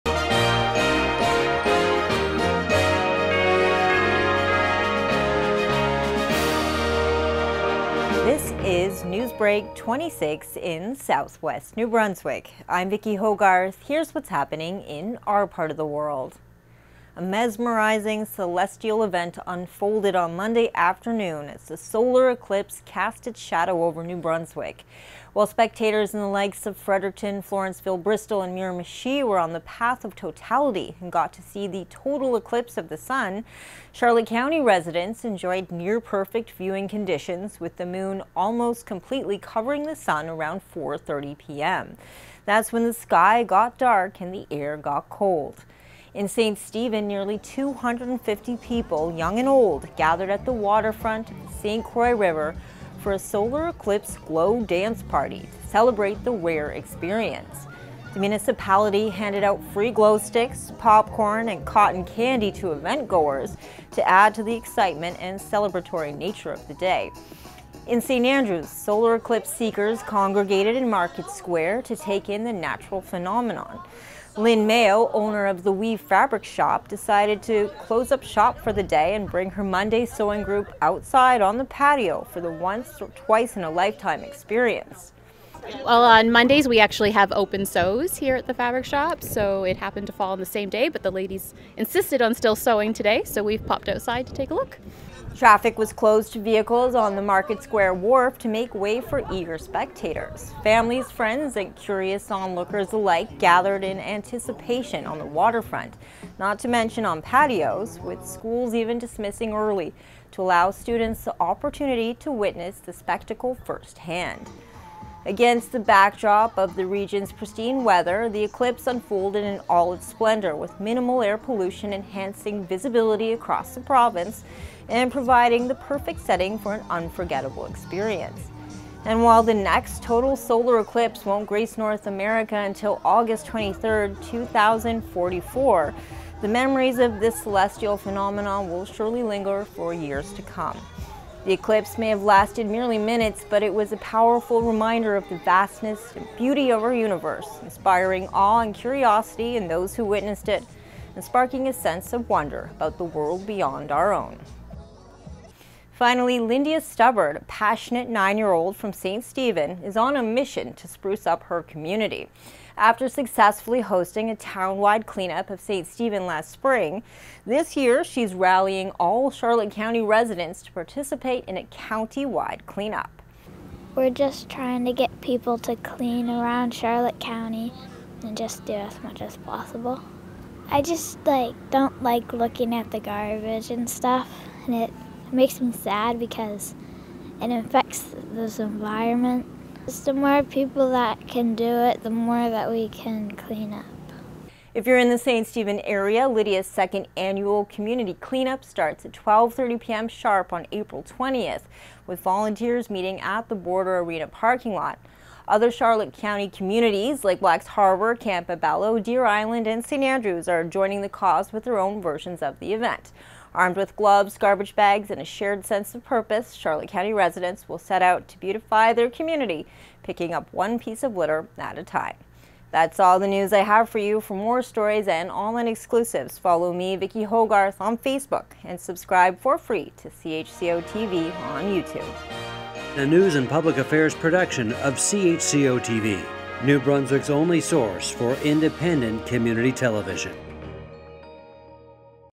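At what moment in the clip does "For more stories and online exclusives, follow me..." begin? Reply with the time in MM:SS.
03:44.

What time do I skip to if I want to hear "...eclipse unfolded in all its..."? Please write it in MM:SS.
01:58.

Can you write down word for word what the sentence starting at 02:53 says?
We're just trying to get people to clean around Charlotte County and just do as much as possible.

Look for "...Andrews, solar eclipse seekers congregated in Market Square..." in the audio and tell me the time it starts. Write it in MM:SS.
01:08.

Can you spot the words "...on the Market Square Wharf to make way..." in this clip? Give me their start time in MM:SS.
01:36.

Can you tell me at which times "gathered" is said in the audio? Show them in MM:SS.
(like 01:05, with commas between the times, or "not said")
00:49, 01:43.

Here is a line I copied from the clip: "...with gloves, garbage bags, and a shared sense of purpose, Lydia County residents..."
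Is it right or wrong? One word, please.
wrong.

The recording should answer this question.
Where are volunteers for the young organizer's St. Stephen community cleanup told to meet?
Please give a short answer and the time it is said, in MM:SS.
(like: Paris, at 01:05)
Border Arena parking lot, at 03:23.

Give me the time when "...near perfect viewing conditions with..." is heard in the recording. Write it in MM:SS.
00:35.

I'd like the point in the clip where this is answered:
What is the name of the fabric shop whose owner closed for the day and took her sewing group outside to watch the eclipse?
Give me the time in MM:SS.
01:15.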